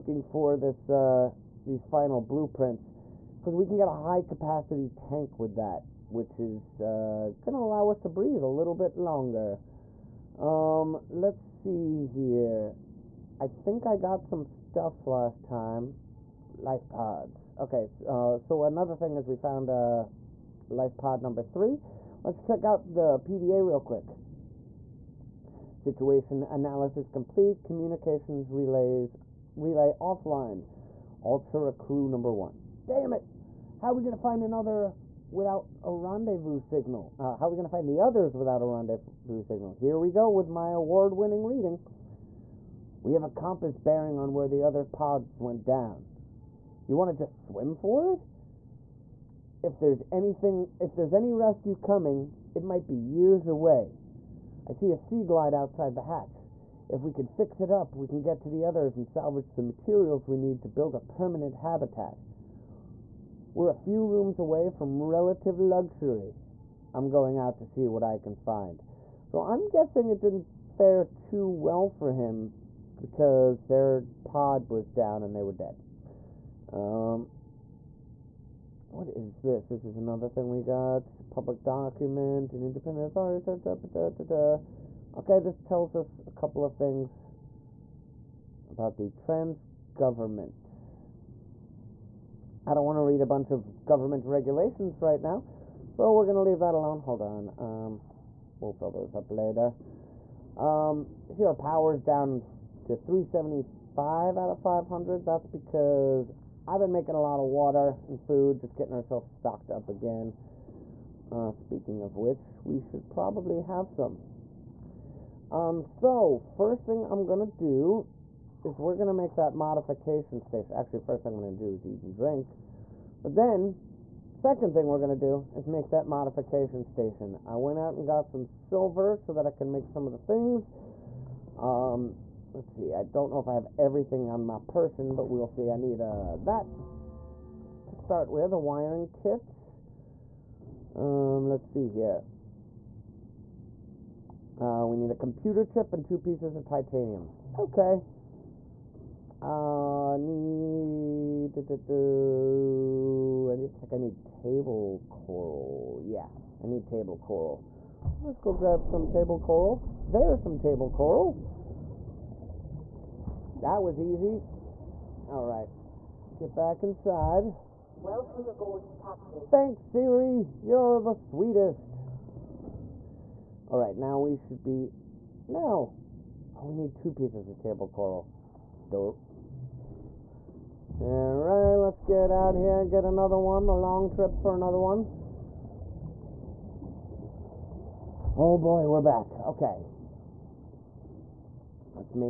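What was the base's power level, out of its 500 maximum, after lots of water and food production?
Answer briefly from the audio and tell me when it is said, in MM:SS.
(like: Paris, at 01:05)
375, at 01:42.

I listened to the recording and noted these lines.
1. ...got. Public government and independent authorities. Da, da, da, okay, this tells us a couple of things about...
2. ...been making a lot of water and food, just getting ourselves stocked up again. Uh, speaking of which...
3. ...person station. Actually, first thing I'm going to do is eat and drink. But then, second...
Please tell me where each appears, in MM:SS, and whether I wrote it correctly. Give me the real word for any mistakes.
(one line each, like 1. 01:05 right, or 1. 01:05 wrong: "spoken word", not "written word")
1. 01:20 wrong: "document", not "government"
2. 01:46 right
3. 01:59 wrong: "modification", not "person".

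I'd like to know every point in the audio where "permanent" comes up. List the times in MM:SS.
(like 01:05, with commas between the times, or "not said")
01:00.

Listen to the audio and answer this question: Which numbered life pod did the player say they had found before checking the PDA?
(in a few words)
3.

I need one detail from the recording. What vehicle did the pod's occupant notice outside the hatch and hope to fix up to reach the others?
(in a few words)
Seaglide.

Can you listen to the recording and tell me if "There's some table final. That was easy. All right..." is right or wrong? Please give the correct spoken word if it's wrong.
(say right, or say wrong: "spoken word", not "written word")
wrong: "coral", not "final".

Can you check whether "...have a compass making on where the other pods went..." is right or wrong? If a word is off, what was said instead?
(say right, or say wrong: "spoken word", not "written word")
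wrong: "bearing", not "making".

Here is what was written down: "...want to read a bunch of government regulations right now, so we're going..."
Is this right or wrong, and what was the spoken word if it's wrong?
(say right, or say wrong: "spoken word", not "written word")
right.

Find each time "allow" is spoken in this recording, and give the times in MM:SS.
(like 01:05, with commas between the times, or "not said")
00:07.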